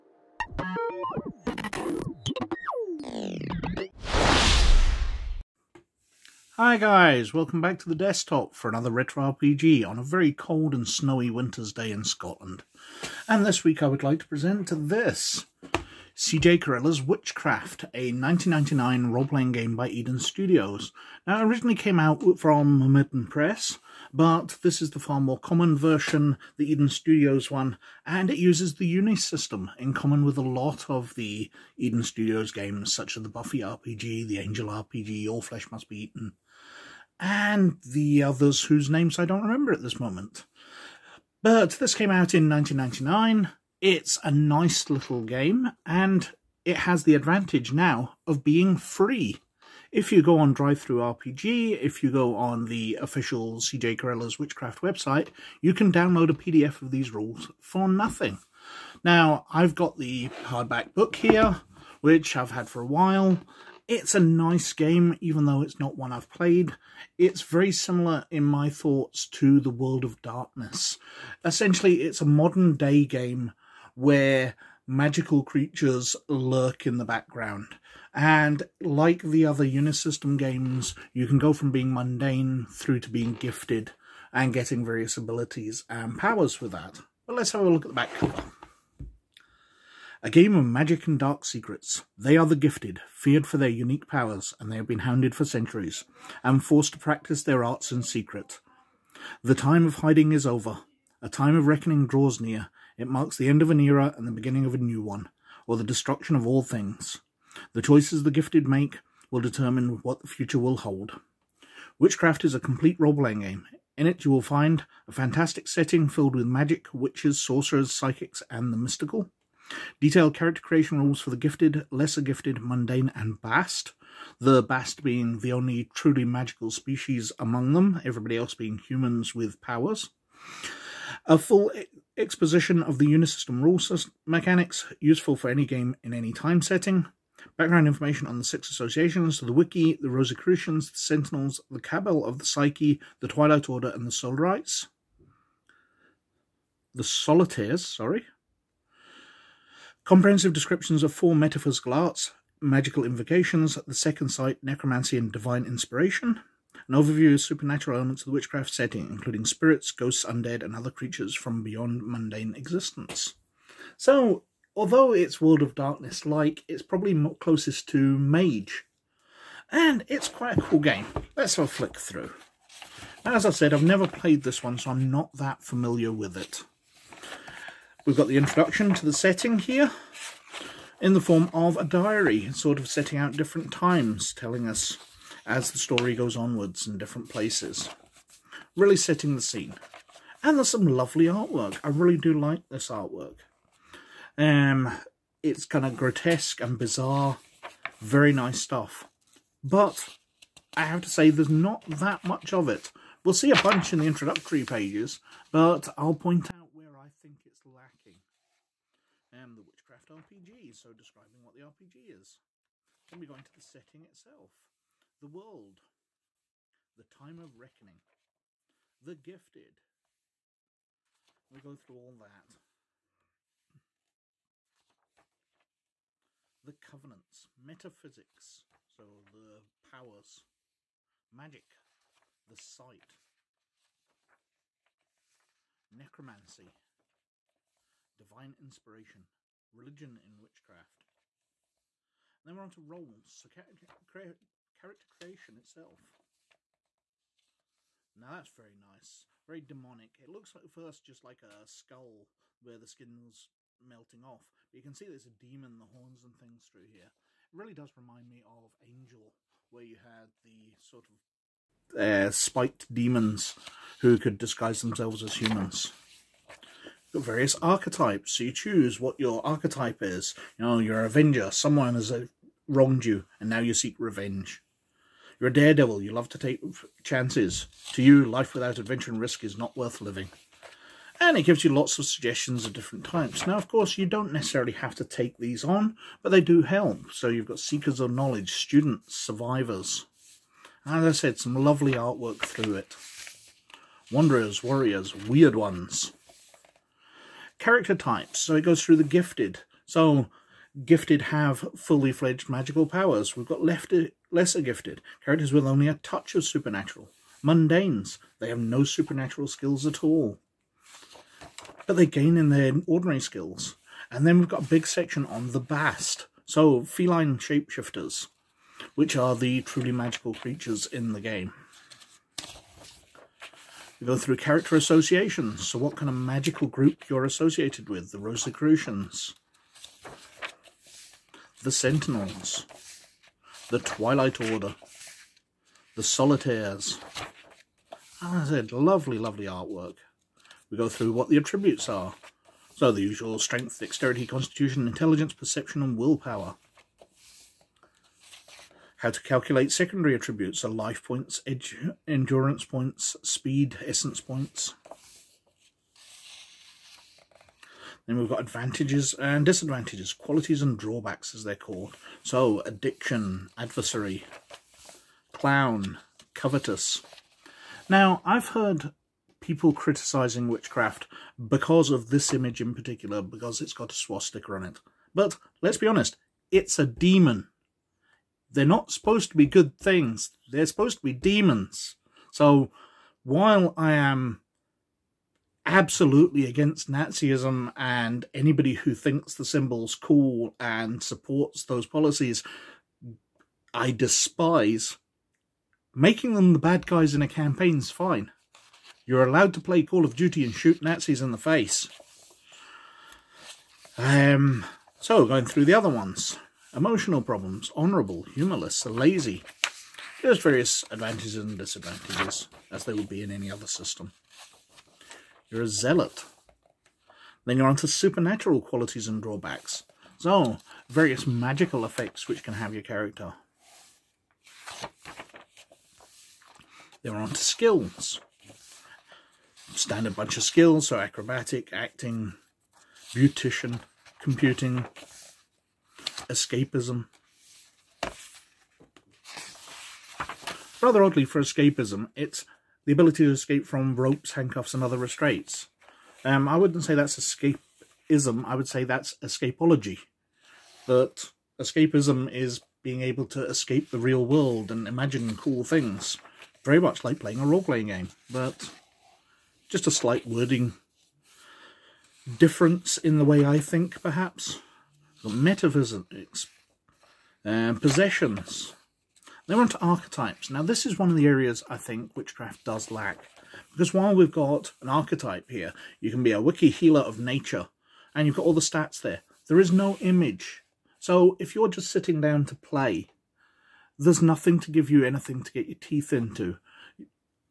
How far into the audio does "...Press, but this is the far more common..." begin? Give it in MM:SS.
00:23.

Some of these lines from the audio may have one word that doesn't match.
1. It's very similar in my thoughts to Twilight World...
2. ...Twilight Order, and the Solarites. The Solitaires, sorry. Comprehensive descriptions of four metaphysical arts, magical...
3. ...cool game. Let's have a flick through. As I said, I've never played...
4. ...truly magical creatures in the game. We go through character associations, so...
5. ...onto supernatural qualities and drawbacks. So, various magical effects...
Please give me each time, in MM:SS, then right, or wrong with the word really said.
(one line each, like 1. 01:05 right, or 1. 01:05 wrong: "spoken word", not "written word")
1. 01:07 wrong: "The", not "Twilight"
2. 02:23 right
3. 02:50 right
4. 05:19 right
5. 06:57 right.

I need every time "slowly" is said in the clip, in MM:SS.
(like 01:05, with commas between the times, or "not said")
not said.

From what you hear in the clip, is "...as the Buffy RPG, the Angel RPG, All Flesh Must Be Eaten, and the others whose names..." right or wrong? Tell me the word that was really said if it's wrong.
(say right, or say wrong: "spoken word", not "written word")
right.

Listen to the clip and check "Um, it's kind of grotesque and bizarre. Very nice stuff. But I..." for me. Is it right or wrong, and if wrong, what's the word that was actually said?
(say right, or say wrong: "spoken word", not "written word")
right.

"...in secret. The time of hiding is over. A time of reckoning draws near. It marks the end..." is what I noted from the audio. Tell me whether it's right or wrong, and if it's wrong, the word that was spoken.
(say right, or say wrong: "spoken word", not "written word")
right.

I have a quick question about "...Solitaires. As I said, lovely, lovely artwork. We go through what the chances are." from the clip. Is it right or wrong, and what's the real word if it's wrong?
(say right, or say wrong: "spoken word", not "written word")
wrong: "attributes", not "chances".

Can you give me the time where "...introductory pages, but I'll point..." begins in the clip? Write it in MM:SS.
03:24.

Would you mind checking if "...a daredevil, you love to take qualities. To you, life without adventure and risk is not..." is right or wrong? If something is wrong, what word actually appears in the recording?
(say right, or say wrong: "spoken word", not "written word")
wrong: "chances", not "qualities".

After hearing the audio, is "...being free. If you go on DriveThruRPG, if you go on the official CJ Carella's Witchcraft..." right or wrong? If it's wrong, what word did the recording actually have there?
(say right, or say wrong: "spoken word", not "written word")
right.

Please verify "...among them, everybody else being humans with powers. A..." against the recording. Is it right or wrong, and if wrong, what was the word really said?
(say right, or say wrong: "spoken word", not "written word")
right.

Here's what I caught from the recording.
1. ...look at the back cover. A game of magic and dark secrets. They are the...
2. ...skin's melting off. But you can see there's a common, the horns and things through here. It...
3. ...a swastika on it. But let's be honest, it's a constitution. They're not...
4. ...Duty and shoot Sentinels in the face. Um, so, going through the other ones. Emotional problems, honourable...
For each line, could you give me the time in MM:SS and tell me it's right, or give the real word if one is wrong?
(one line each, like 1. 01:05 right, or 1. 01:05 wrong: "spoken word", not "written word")
1. 01:27 right
2. 04:12 wrong: "demon", not "common"
3. 06:13 wrong: "demon", not "constitution"
4. 06:40 wrong: "Nazis", not "Sentinels".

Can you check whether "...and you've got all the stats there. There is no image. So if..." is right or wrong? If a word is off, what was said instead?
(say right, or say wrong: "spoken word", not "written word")
right.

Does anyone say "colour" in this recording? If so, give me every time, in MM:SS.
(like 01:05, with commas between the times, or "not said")
not said.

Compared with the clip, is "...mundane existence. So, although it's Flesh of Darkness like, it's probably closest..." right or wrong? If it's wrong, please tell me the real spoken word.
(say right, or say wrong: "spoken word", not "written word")
wrong: "World", not "Flesh".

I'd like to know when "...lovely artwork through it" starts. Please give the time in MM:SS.
04:51.